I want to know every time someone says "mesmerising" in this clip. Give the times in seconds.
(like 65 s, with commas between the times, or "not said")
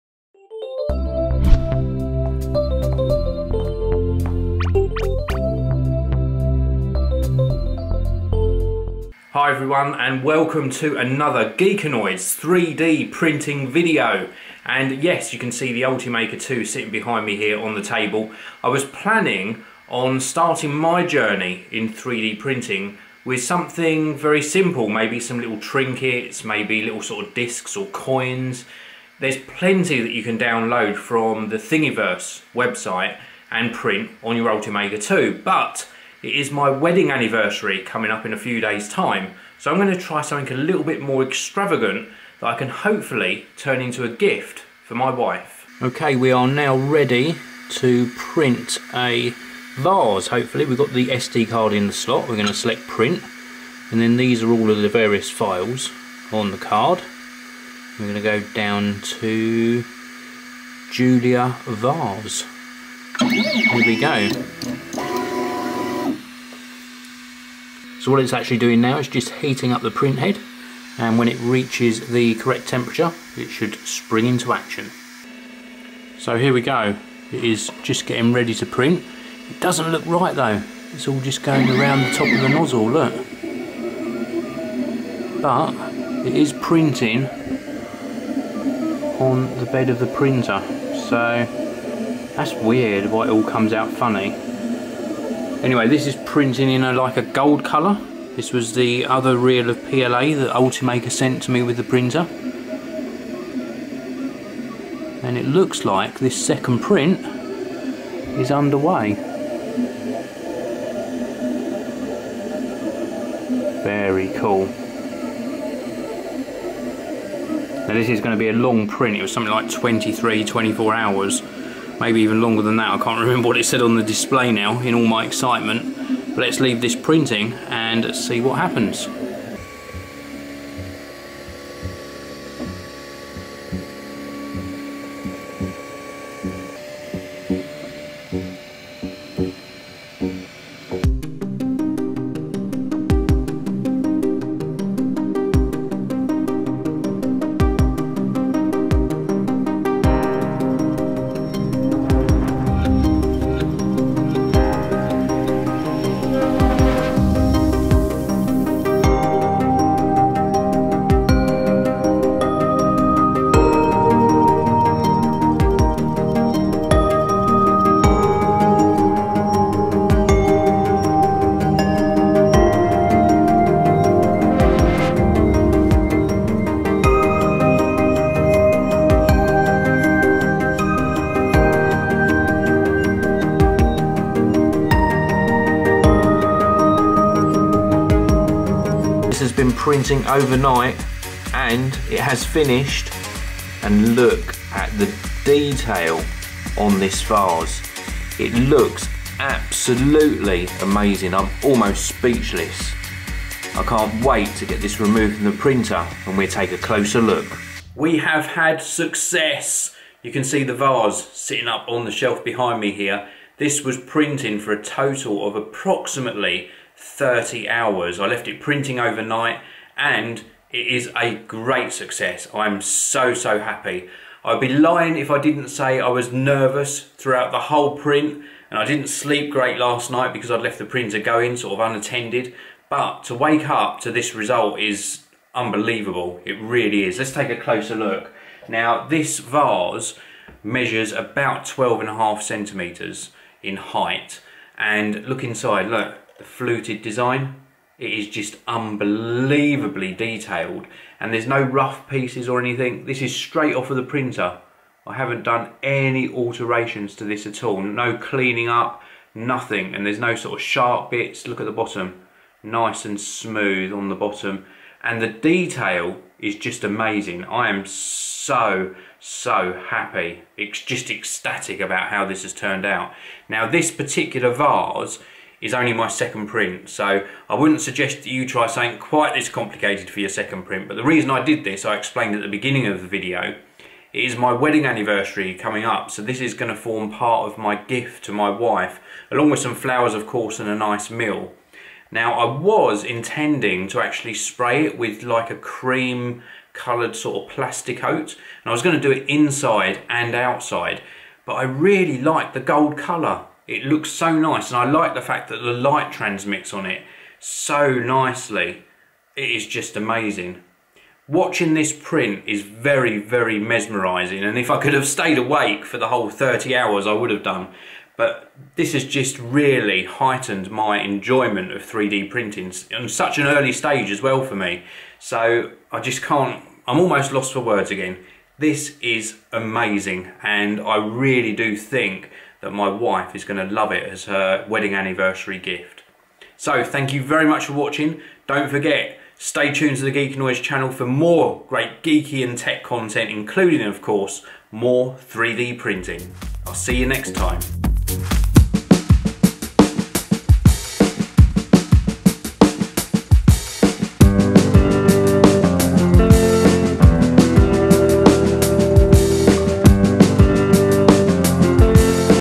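313 s.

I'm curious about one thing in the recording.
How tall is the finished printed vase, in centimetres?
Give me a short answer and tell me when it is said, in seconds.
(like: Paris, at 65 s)
12.5, at 241 s.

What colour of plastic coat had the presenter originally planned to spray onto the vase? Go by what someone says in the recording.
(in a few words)
Cream.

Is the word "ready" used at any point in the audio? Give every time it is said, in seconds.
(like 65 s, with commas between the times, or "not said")
46 s, 78 s.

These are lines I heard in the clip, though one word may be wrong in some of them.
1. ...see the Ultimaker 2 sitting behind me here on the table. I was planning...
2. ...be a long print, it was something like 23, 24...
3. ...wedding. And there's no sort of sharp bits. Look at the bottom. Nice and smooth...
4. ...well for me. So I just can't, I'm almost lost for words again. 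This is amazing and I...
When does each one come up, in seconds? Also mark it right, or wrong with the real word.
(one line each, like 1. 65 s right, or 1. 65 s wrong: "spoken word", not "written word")
1. 15 s right
2. 118 s right
3. 259 s wrong: "nothing", not "wedding"
4. 324 s right.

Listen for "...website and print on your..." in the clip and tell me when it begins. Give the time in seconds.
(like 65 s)
32 s.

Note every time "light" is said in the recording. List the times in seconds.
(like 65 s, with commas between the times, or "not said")
305 s.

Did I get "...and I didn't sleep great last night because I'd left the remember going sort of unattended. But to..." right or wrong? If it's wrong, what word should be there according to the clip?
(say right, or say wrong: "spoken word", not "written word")
wrong: "printer", not "remember".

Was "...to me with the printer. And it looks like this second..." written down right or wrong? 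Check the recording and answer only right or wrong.
right.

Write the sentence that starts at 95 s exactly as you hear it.
Anyway, this is printing in a, like a gold colour.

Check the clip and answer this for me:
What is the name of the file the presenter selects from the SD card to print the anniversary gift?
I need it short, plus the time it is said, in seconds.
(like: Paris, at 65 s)
Julia Vase, at 60 s.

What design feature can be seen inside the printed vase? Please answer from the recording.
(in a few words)
Fluted design.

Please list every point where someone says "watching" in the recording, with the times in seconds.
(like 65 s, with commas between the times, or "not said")
311 s, 337 s.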